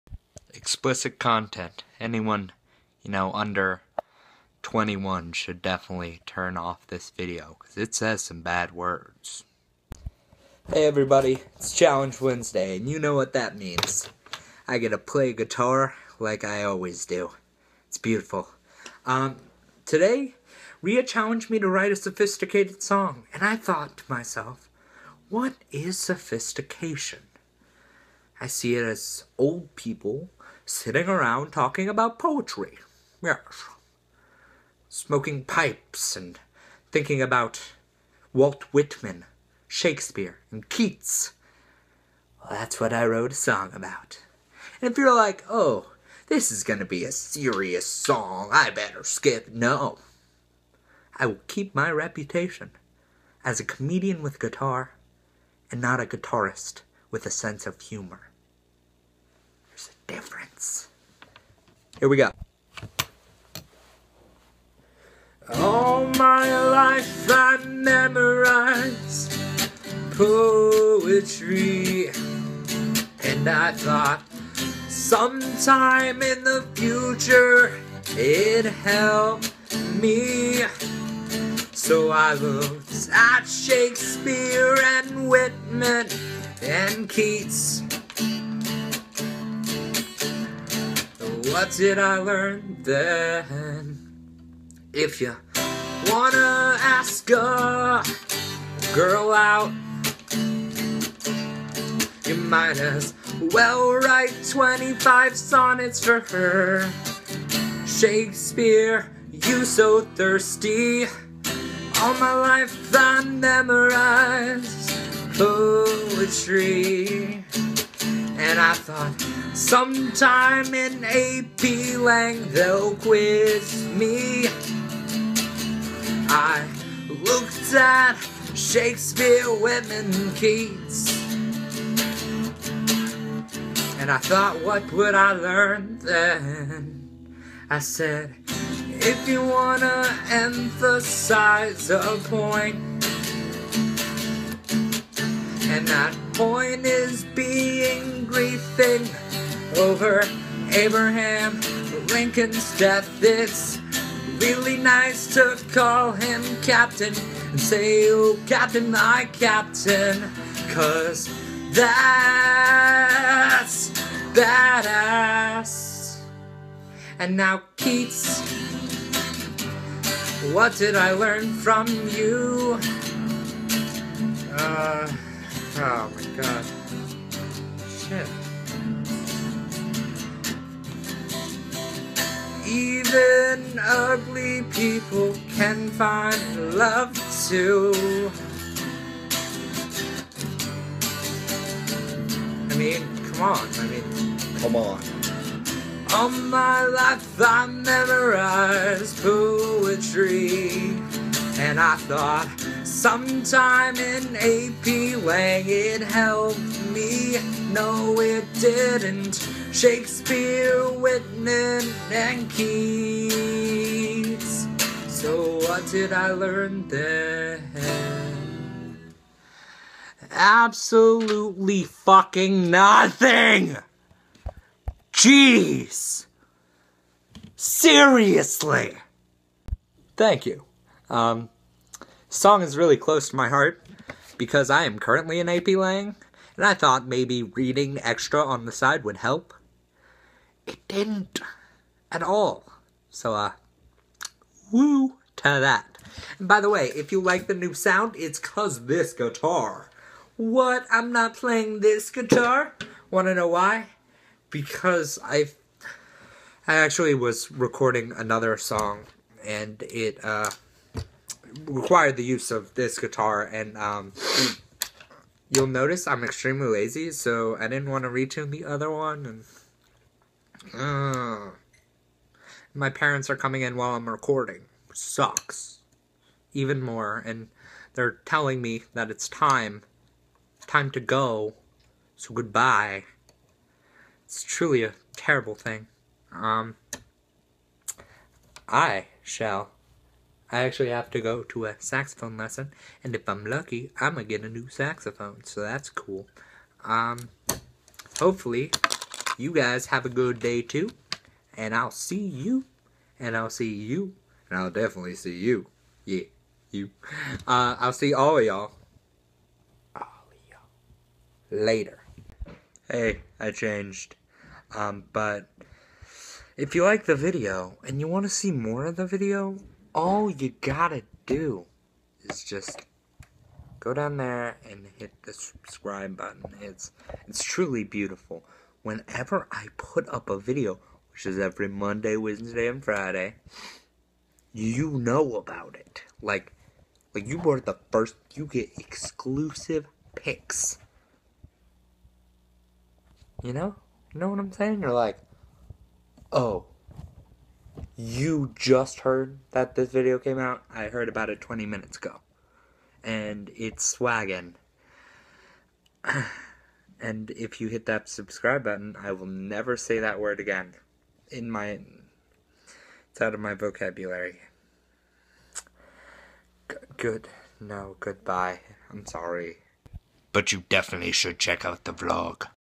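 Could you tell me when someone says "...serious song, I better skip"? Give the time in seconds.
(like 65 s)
47 s.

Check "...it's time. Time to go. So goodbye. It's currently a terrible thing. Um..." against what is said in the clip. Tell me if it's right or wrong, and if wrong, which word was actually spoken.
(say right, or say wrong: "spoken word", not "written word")
wrong: "truly", not "currently".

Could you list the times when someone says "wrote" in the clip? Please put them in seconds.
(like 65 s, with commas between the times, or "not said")
43 s.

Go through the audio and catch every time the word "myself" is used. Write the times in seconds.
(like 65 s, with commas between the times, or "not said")
24 s.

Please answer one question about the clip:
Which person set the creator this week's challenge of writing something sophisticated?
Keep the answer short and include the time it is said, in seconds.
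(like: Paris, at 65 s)
Rhea, at 20 s.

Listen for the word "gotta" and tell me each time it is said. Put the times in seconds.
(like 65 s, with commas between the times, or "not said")
320 s.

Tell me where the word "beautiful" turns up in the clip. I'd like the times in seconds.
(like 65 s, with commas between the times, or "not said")
17 s, 327 s.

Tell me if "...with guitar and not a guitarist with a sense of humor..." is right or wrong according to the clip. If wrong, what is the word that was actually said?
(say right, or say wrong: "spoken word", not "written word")
right.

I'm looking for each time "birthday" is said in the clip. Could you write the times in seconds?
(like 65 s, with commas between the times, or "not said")
not said.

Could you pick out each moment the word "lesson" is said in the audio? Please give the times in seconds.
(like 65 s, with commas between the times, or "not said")
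292 s.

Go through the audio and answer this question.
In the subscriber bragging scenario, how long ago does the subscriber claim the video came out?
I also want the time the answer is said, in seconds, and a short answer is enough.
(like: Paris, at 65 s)
20 minutes, at 351 s.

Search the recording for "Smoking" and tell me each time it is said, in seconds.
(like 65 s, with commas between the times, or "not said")
34 s.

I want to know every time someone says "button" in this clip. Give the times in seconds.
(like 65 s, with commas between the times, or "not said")
326 s, 358 s.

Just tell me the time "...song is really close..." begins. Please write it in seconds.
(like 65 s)
232 s.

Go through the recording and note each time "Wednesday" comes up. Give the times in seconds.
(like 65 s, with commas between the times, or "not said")
12 s, 332 s.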